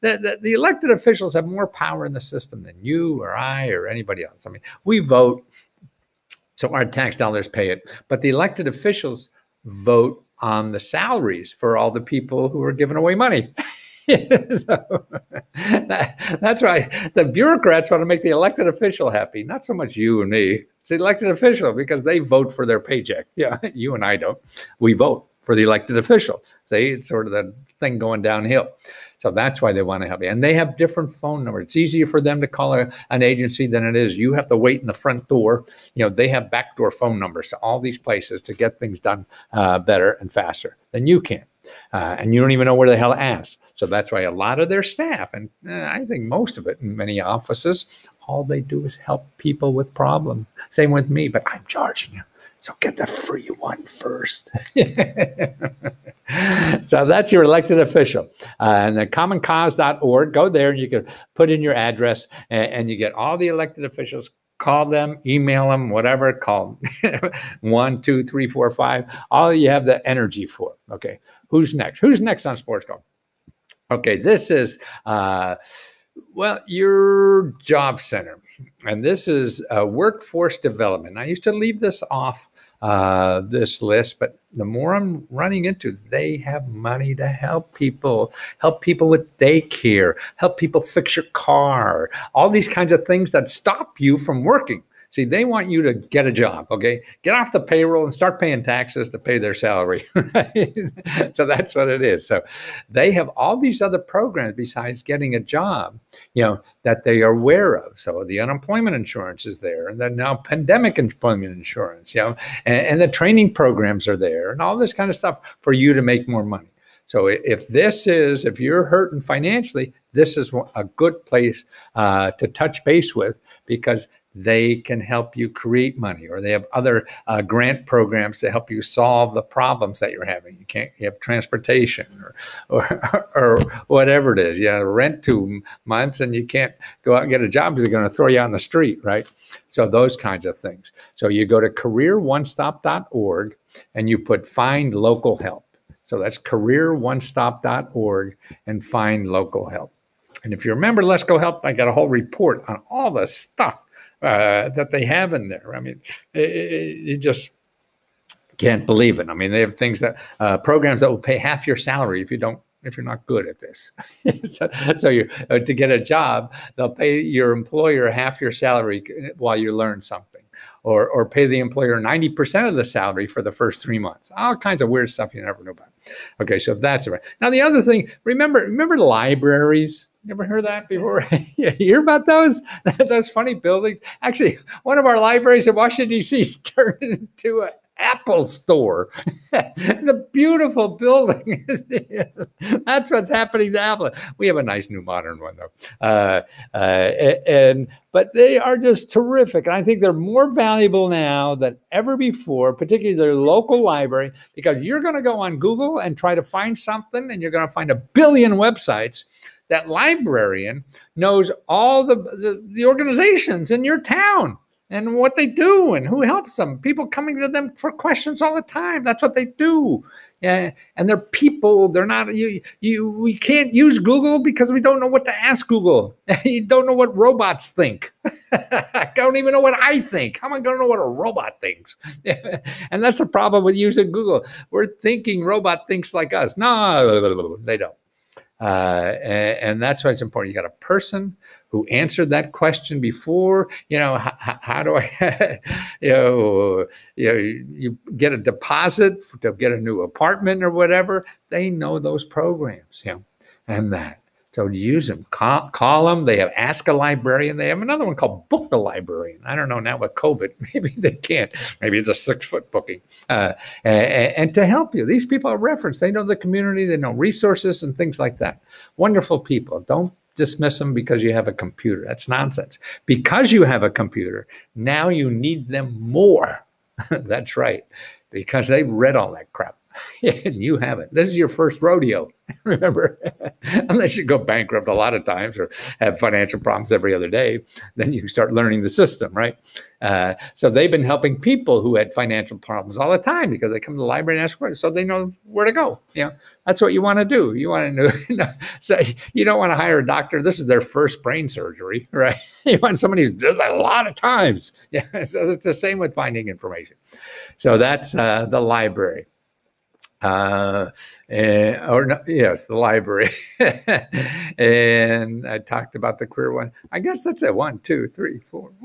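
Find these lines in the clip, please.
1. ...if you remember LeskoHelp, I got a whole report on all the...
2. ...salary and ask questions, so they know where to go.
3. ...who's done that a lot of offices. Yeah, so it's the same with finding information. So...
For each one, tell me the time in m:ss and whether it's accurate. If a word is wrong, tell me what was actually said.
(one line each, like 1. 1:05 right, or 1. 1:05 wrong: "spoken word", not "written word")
1. 2:30 right
2. 4:54 wrong: "library", not "salary"
3. 5:03 wrong: "times", not "offices".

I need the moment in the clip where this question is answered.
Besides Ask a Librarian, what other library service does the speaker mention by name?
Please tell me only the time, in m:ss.
4:18.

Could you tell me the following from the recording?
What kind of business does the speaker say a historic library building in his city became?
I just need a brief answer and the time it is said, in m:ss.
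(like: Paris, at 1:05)
An Apple store, at 3:07.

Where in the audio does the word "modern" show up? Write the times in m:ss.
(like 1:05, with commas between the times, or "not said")
3:15.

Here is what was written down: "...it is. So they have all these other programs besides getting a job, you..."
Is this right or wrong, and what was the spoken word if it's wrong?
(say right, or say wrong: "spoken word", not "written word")
right.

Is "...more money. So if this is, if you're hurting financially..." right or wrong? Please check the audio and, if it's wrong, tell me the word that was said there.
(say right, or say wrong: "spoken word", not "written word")
right.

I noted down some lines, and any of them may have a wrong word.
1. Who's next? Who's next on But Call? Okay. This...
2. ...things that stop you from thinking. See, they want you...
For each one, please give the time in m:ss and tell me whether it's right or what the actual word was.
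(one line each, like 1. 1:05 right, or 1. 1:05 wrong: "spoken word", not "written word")
1. 1:11 wrong: "Sports", not "But"
2. 1:33 wrong: "working", not "thinking".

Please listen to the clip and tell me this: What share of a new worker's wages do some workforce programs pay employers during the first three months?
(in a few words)
90 percent.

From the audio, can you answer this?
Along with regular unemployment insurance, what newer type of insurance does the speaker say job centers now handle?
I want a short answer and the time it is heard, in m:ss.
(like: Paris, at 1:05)
Pandemic employment insurance, at 1:50.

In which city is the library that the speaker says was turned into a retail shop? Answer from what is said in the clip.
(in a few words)
Washington, D.C.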